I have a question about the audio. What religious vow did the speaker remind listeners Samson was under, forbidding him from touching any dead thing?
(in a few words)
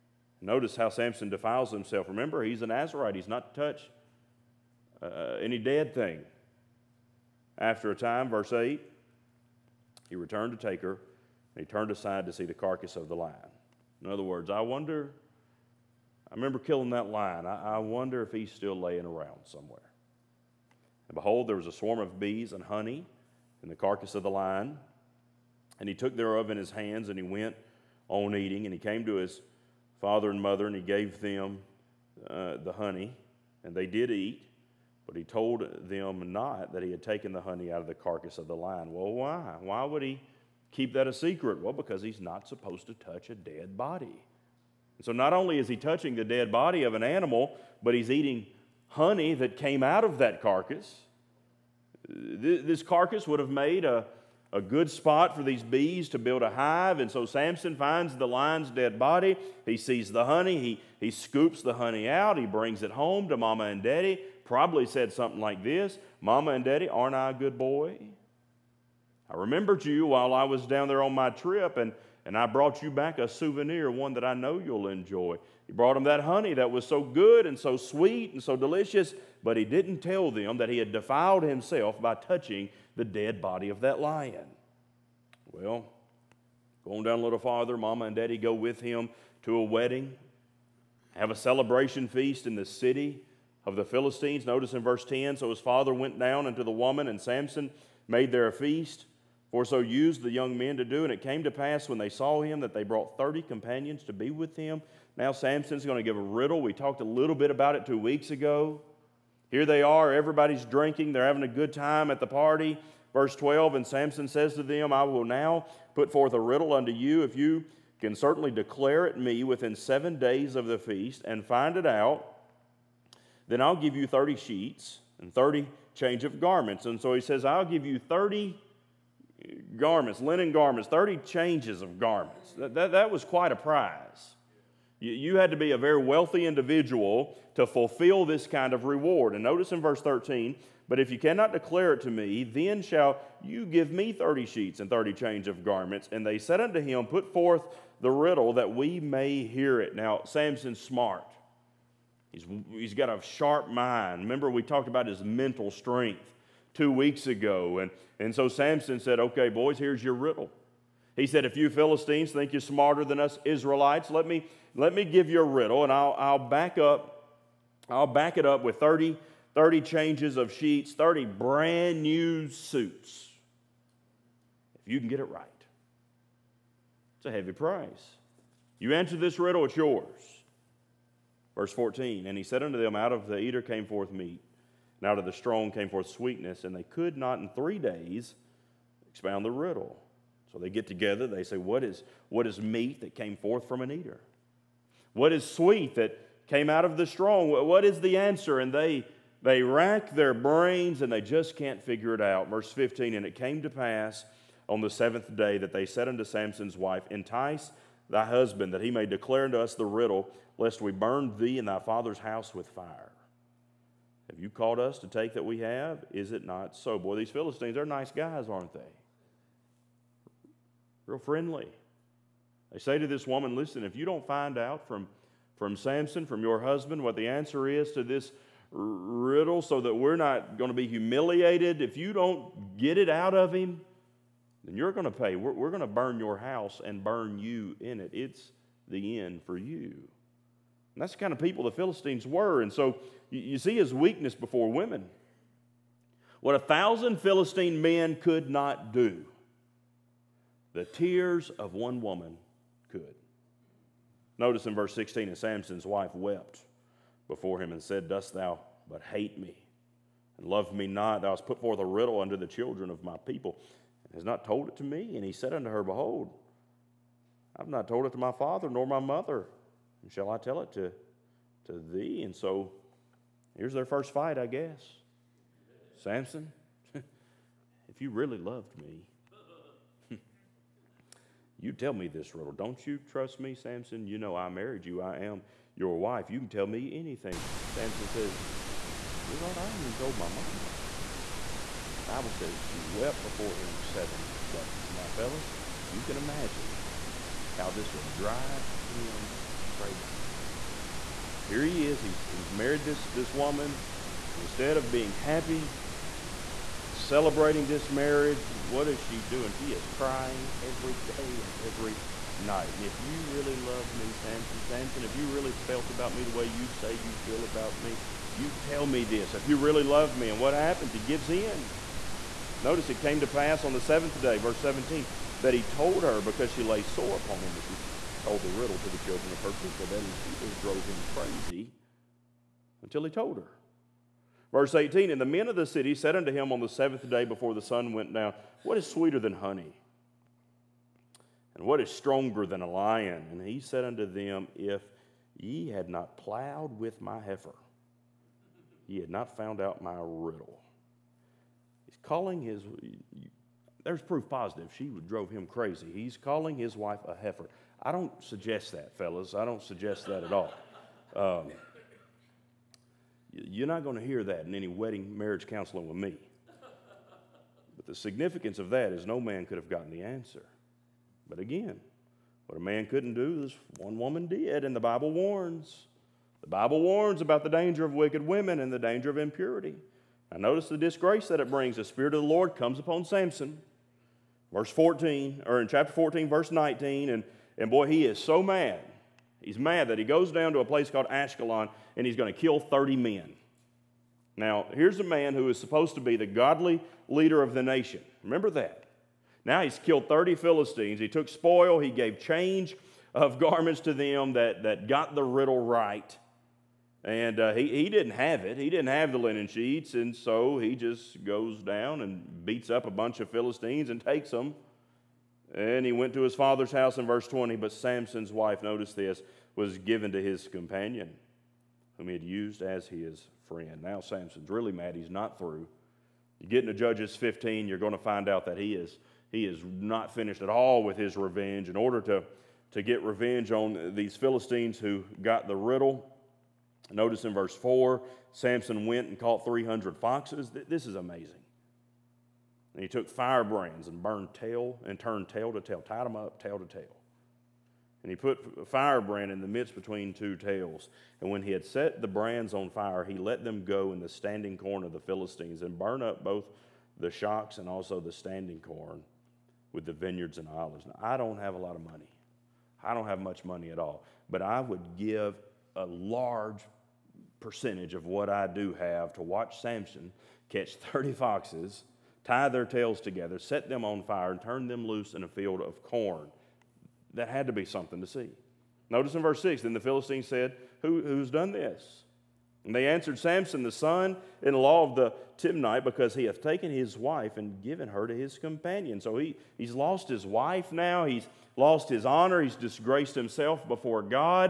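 Nazarite.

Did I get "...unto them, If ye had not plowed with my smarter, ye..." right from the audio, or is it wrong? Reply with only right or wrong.
wrong.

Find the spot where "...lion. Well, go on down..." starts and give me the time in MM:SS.
01:24.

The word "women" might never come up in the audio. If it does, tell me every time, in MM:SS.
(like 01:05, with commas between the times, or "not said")
04:04, 06:18.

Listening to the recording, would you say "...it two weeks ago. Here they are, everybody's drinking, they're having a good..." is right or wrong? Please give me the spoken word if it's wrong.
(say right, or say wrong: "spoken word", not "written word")
right.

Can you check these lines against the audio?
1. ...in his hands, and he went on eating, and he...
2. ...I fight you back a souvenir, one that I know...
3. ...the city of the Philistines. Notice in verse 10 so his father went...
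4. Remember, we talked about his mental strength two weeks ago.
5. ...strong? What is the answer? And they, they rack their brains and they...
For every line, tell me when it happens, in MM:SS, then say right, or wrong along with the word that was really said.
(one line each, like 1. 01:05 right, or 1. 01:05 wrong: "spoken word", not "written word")
1. 00:26 right
2. 01:12 wrong: "brought", not "fight"
3. 01:32 right
4. 02:34 right
5. 03:17 right.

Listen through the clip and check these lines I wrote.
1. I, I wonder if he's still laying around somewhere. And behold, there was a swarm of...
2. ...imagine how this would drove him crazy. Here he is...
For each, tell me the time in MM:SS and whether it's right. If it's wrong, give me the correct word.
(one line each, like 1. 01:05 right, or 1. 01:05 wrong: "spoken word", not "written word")
1. 00:17 right
2. 04:56 wrong: "drive", not "drove".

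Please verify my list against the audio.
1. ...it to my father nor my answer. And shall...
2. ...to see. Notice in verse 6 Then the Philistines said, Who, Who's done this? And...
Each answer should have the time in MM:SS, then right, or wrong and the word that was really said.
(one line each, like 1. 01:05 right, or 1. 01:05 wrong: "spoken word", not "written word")
1. 04:28 wrong: "mother", not "answer"
2. 07:58 right.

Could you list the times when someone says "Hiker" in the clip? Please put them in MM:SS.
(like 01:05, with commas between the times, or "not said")
not said.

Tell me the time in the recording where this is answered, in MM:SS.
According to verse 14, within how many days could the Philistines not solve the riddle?
03:07.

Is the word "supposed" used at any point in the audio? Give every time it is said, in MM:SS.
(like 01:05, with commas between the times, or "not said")
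00:42, 06:35.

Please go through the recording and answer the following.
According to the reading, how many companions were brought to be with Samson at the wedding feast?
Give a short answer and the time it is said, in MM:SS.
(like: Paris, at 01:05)
30, at 01:43.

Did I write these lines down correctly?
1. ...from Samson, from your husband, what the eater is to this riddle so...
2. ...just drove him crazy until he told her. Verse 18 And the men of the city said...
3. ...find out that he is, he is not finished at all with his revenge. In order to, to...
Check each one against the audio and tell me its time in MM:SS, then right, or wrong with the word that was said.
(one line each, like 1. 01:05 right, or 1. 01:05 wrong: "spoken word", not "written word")
1. 03:45 wrong: "answer", not "eater"
2. 05:30 right
3. 07:07 right.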